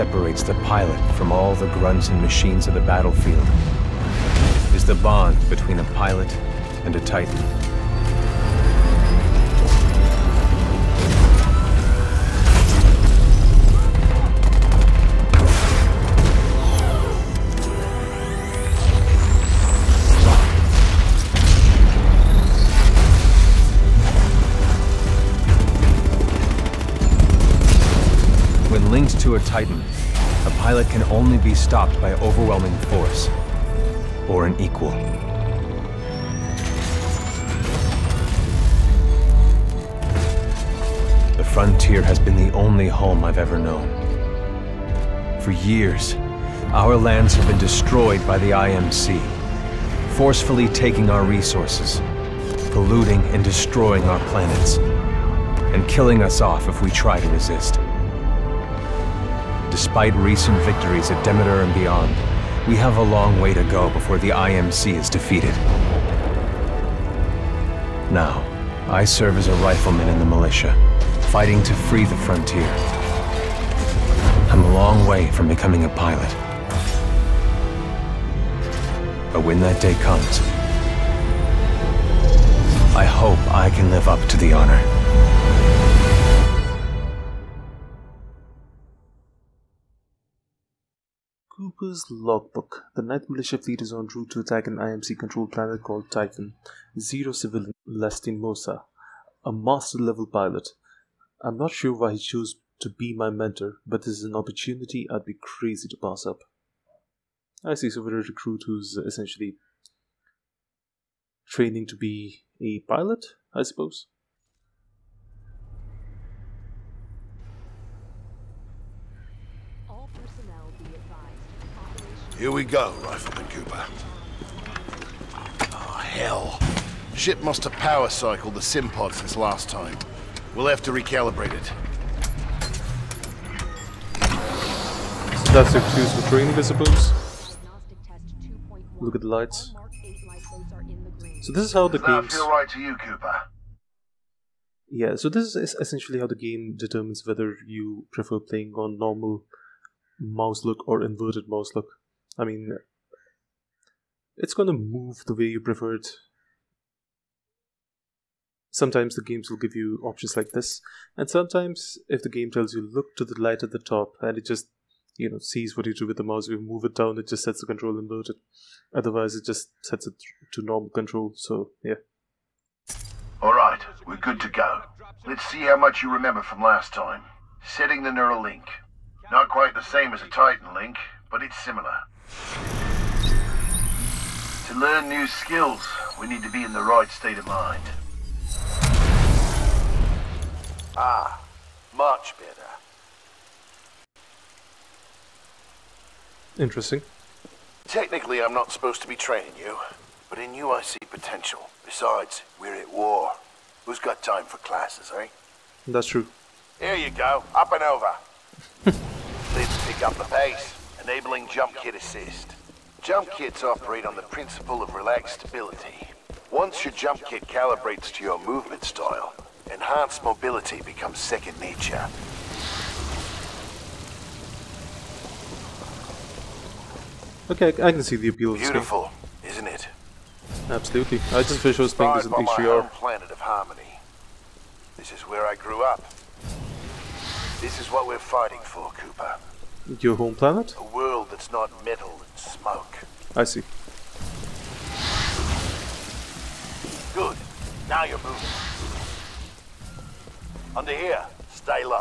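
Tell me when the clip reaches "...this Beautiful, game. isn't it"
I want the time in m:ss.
3:48.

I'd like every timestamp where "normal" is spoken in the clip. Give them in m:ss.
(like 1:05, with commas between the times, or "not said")
2:28, 2:50.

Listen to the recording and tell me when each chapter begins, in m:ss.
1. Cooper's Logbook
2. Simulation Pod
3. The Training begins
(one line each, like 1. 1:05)
1. 1:30
2. 1:55
3. 3:00.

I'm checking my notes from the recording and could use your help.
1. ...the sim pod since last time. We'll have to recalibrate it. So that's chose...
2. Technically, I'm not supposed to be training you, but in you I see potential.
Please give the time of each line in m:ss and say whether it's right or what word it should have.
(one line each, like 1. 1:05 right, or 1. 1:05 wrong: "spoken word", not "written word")
1. 2:08 wrong: "excuse", not "chose"
2. 3:17 right.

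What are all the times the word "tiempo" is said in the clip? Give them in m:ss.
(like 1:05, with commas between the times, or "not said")
not said.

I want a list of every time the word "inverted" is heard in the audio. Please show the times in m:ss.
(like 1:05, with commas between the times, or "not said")
2:31, 2:47.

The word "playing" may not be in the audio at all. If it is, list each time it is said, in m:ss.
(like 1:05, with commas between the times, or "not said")
2:28, 3:51.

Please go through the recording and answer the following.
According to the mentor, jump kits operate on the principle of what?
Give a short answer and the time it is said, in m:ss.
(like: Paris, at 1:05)
relaxed stability, at 3:34.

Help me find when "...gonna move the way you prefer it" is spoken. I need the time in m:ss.
2:34.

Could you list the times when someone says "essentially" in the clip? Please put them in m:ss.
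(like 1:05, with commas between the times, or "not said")
1:49, 2:25.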